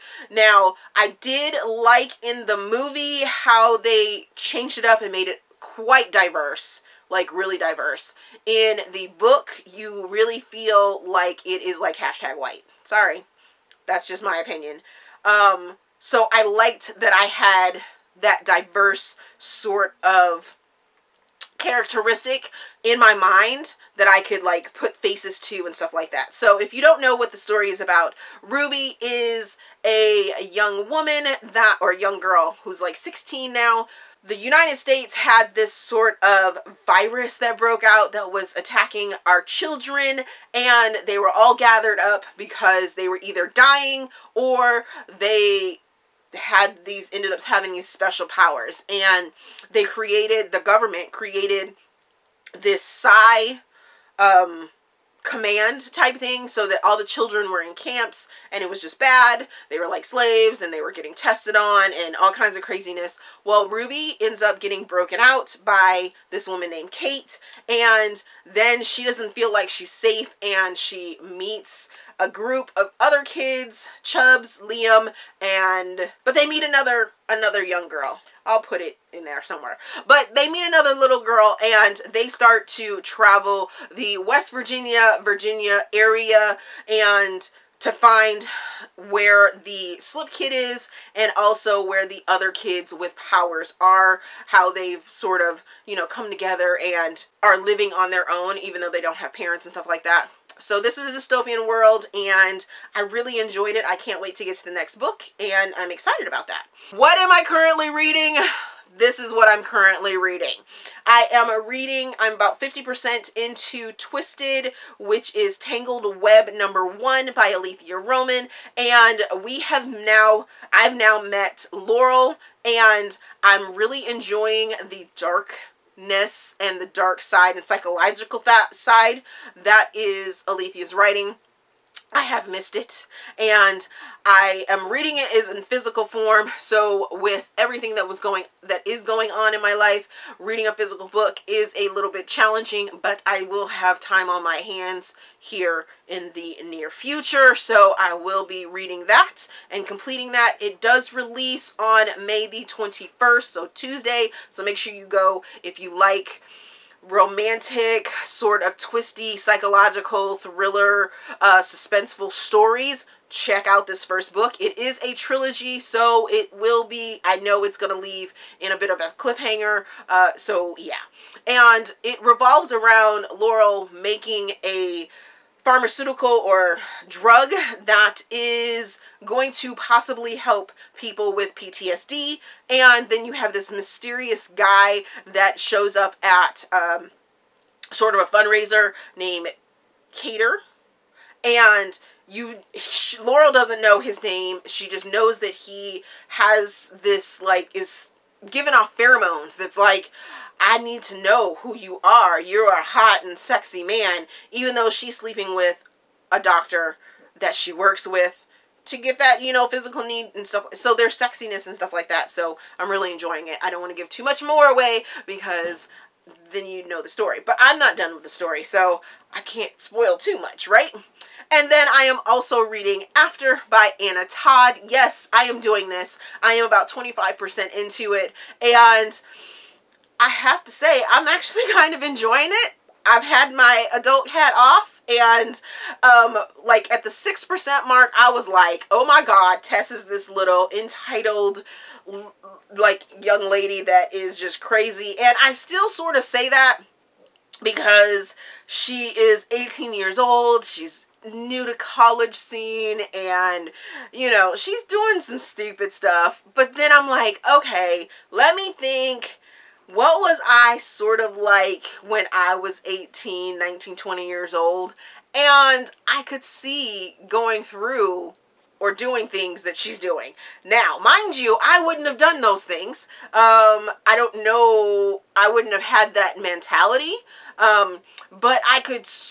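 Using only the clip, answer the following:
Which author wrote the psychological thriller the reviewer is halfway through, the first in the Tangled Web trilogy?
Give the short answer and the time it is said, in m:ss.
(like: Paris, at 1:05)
Aleatha Romig, at 1:57.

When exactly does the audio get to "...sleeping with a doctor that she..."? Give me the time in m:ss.
3:25.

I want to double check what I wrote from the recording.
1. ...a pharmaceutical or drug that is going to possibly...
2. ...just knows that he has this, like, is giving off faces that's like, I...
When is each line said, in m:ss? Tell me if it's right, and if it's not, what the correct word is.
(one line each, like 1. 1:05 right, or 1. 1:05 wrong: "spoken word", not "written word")
1. 2:54 right
2. 3:14 wrong: "pheromones", not "faces".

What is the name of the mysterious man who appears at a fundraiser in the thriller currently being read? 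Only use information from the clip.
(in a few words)
Cater.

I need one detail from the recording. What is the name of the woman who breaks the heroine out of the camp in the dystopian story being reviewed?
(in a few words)
Kate.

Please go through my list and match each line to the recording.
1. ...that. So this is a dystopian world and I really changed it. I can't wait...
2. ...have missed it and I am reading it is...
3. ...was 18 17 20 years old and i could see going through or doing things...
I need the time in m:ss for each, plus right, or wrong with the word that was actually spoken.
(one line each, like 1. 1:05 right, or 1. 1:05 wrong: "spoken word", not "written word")
1. 1:40 wrong: "enjoyed", not "changed"
2. 2:12 right
3. 4:22 wrong: "19", not "17".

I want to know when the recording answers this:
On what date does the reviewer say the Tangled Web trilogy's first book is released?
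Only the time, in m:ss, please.
2:32.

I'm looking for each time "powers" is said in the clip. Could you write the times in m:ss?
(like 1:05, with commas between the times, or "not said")
0:48, 1:33.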